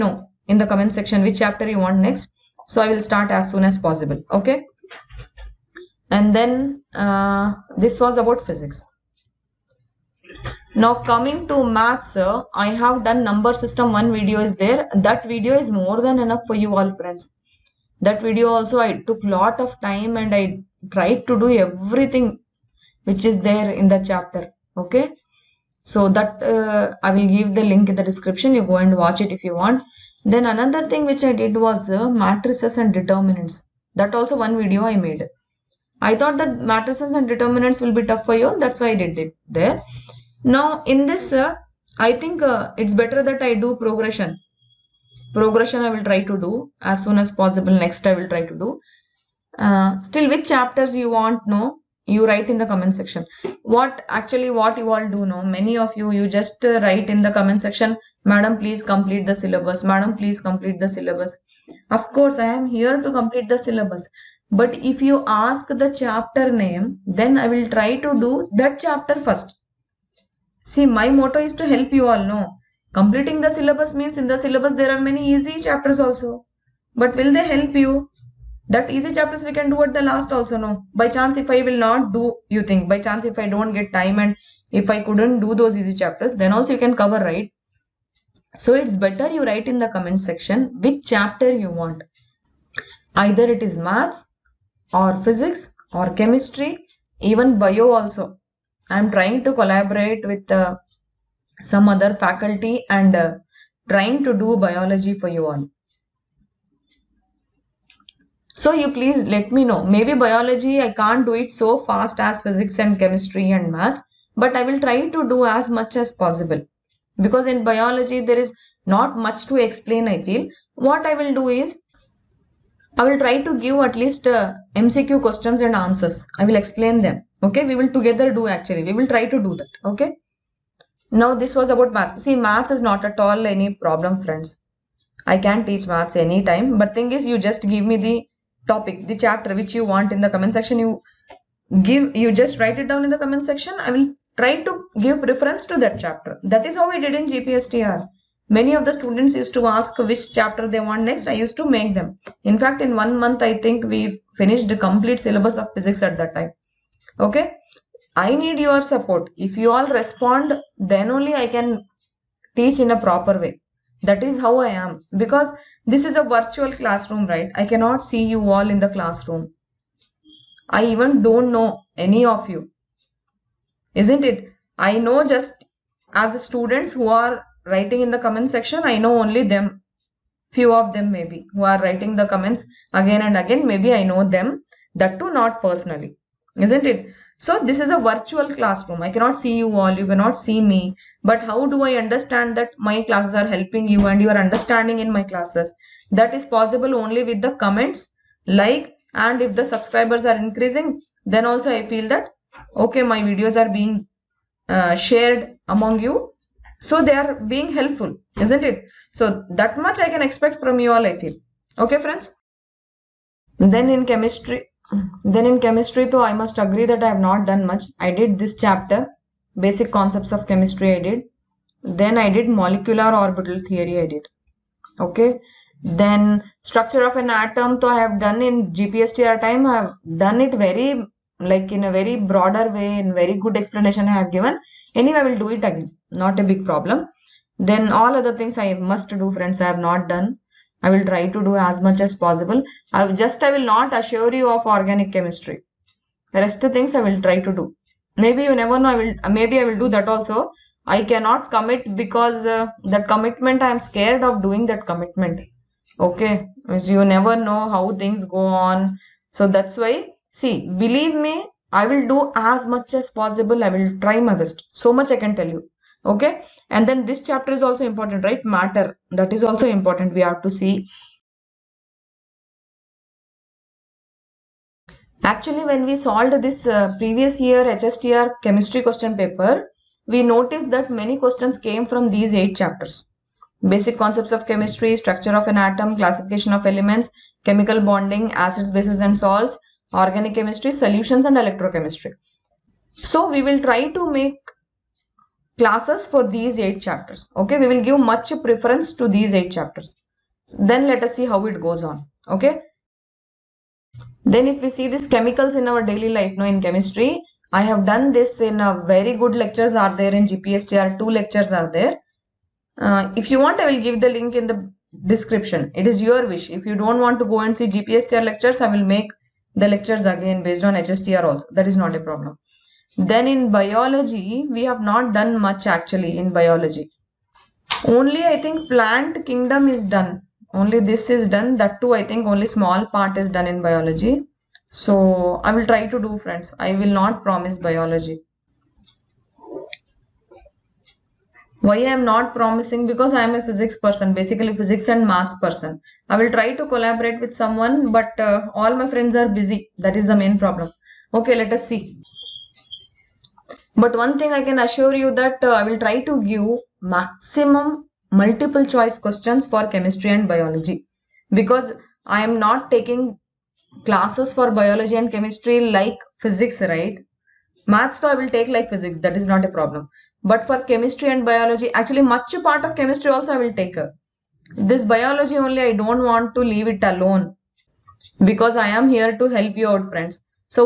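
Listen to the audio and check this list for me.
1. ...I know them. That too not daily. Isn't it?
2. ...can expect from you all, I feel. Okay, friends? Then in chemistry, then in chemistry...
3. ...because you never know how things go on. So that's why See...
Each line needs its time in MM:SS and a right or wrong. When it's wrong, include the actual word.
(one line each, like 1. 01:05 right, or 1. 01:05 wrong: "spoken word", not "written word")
1. 03:03 wrong: "personally", not "daily"
2. 03:30 right
3. 04:16 right.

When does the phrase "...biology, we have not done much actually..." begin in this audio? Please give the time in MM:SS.
05:23.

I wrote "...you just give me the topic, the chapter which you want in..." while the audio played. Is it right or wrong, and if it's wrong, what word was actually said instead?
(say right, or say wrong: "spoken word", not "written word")
right.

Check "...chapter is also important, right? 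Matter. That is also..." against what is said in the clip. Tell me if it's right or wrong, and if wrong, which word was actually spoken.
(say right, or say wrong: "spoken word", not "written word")
right.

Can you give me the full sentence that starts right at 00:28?
You go and watch it if you want.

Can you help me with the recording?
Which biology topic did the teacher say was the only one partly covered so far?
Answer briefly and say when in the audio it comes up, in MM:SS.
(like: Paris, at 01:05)
Plant kingdom, at 05:28.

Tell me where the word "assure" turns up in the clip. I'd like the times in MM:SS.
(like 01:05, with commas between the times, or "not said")
04:03, 05:54.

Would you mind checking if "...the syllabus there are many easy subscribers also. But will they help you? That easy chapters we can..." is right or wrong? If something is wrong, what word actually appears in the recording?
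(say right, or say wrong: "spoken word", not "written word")
wrong: "chapters", not "subscribers".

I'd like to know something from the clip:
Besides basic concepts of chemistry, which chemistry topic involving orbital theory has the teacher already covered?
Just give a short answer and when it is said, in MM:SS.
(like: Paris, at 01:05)
Molecular orbital theory, at 03:42.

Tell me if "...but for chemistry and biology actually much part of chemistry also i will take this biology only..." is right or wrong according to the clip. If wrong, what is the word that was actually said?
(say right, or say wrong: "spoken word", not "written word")
right.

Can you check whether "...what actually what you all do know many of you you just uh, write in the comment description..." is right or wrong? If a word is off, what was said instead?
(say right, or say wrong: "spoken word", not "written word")
wrong: "section", not "description".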